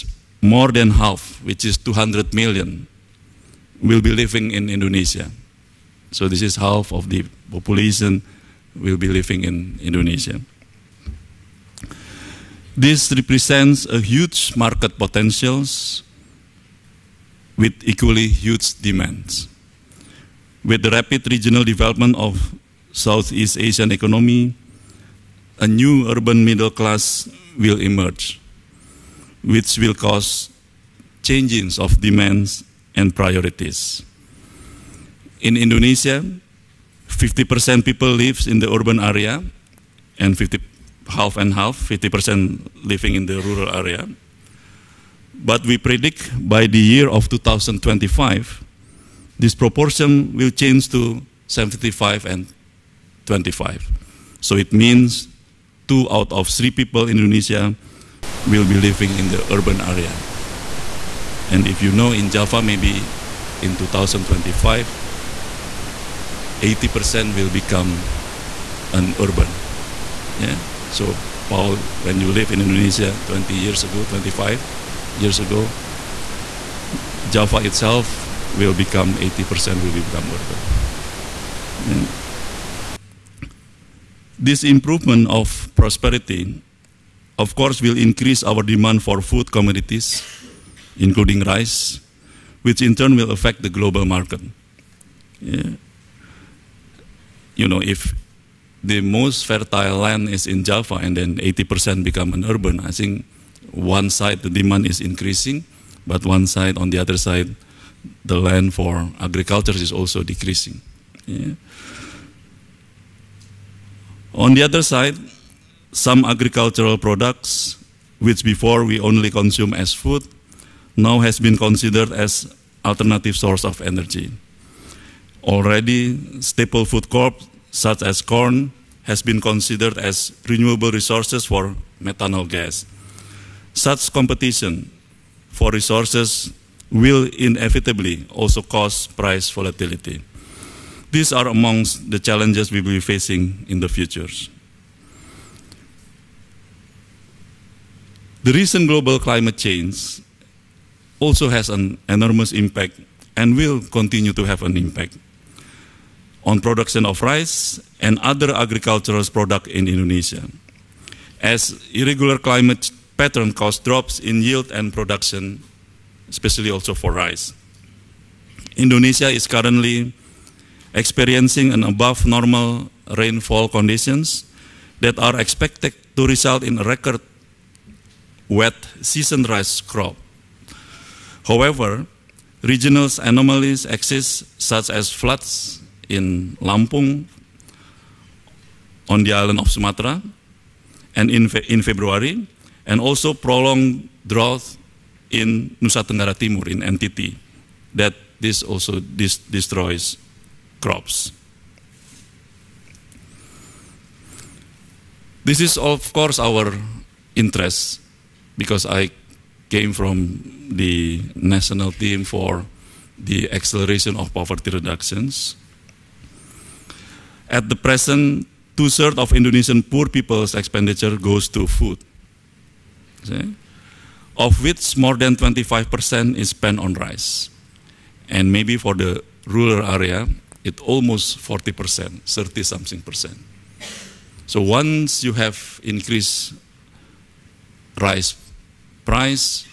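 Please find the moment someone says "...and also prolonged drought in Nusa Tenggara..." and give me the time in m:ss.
3:12.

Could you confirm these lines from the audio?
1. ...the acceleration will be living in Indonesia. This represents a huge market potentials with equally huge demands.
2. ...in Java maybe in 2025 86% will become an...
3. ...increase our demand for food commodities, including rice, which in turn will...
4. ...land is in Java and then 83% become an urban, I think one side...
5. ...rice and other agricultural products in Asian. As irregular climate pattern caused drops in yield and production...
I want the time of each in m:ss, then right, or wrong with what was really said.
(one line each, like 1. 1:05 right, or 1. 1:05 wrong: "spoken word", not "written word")
1. 0:07 wrong: "population", not "acceleration"
2. 1:02 wrong: "80", not "86"
3. 1:27 right
4. 1:39 wrong: "80", not "83"
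5. 2:37 wrong: "Indonesia", not "Asian".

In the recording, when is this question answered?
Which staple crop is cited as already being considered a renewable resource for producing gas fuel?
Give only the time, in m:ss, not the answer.
2:08.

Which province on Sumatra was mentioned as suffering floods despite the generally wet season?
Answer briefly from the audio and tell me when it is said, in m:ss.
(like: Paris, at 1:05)
Lampung, at 3:06.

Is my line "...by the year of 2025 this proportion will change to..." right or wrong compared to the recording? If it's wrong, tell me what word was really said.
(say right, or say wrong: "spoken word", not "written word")
right.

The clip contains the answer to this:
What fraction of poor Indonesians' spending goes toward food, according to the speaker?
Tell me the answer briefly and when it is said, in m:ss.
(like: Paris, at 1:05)
two-thirds, at 3:38.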